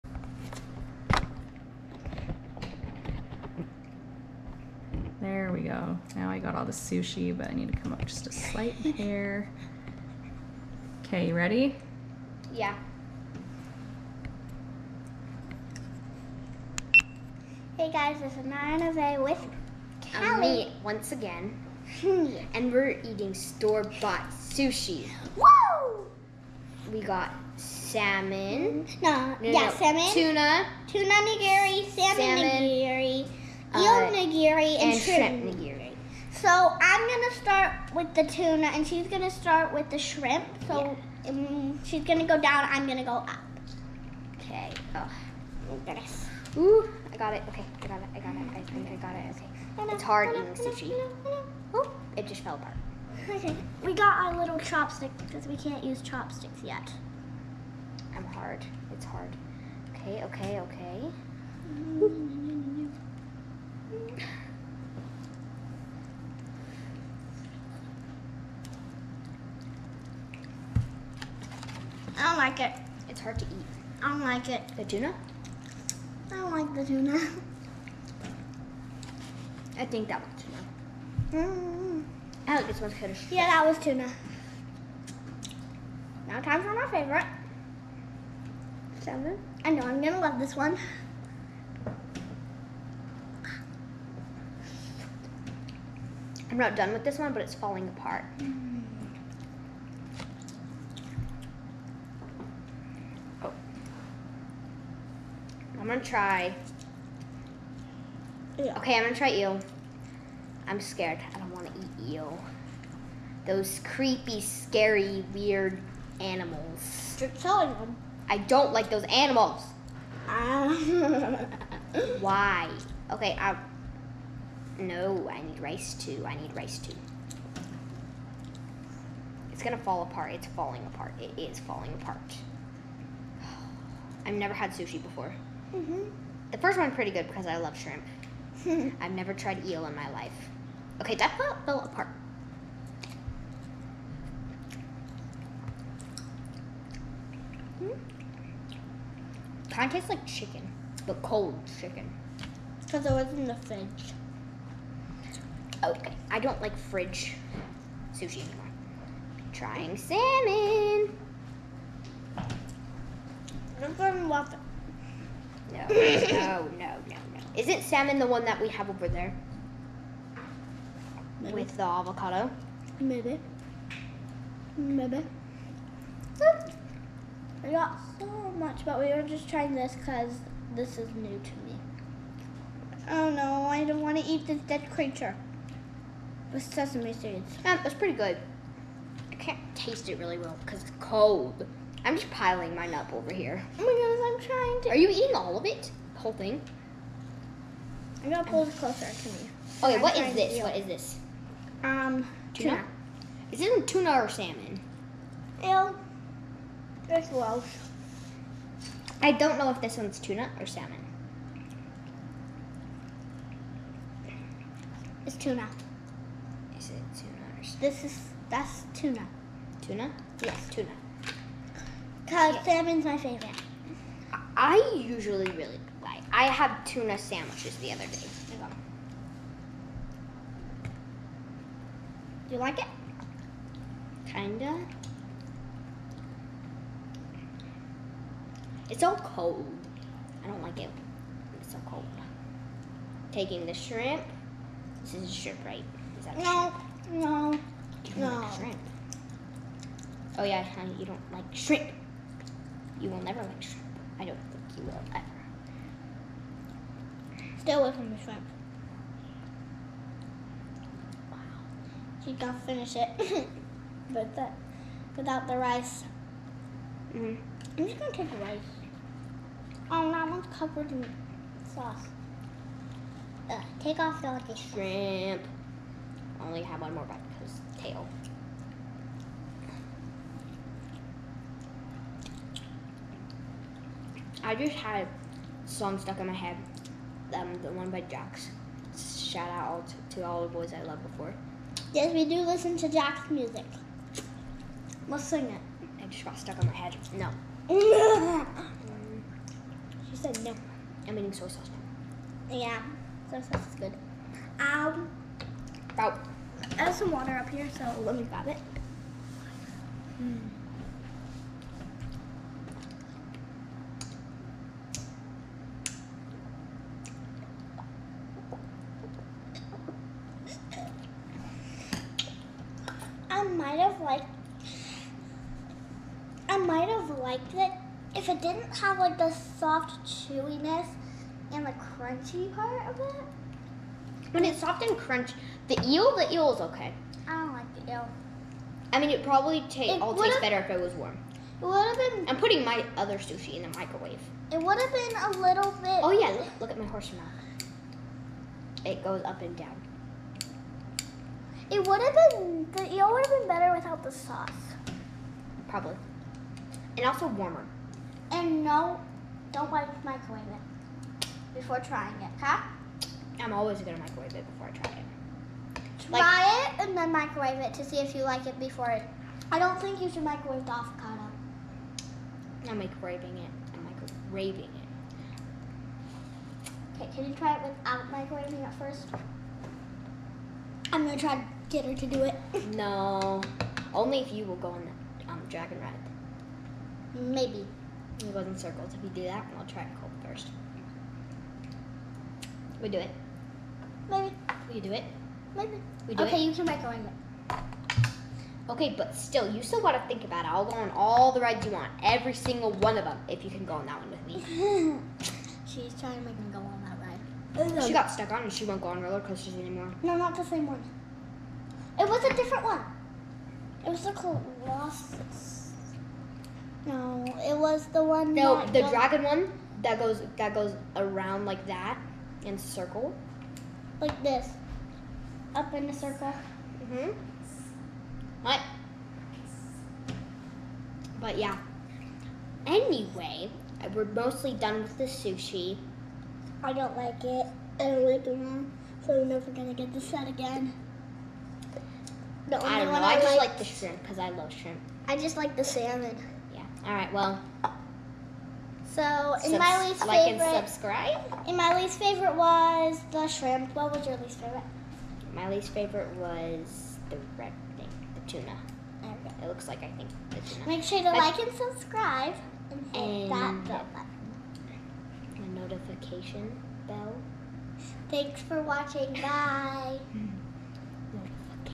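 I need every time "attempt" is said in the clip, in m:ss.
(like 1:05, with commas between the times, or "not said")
not said.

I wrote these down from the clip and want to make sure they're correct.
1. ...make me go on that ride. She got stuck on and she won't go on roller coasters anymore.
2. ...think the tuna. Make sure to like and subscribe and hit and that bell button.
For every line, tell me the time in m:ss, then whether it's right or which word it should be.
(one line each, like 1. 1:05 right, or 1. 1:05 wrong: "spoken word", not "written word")
1. 6:46 right
2. 7:39 right.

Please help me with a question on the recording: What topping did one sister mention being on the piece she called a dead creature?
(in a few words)
sesame seeds.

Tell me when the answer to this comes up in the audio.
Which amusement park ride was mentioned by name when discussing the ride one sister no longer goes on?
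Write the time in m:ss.
6:54.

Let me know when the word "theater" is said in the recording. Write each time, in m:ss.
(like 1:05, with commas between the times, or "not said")
not said.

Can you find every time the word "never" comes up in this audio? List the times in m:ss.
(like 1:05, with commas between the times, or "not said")
2:14, 2:19, 4:13, 7:19.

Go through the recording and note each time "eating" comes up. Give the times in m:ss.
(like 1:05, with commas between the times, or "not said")
0:23, 0:50, 3:15, 5:01.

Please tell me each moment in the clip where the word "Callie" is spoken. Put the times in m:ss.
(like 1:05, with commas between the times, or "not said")
0:20.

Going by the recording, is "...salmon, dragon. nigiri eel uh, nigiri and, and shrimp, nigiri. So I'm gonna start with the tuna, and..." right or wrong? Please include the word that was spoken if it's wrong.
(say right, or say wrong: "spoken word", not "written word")
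wrong: "salmon", not "dragon".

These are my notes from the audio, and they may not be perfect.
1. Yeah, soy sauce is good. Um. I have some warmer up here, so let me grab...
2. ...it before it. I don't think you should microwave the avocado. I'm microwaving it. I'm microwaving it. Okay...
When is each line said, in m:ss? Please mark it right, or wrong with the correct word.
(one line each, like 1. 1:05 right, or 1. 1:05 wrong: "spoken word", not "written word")
1. 5:02 wrong: "water", not "warmer"
2. 6:08 right.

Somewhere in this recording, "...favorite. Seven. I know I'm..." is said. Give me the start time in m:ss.
1:26.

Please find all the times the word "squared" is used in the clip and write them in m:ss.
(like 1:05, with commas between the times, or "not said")
not said.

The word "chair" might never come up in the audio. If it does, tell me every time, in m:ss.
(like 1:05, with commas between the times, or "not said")
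not said.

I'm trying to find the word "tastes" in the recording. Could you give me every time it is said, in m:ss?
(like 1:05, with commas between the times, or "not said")
2:29, 3:09, 5:40.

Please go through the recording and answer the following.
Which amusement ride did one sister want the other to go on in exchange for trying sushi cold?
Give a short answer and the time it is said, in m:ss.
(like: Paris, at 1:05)
dragon ride, at 6:25.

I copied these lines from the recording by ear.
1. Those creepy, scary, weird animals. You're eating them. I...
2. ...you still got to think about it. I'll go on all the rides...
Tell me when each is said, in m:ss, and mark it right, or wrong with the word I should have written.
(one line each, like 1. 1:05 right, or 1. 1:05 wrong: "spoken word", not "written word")
1. 1:53 wrong: "killing", not "eating"
2. 6:39 right.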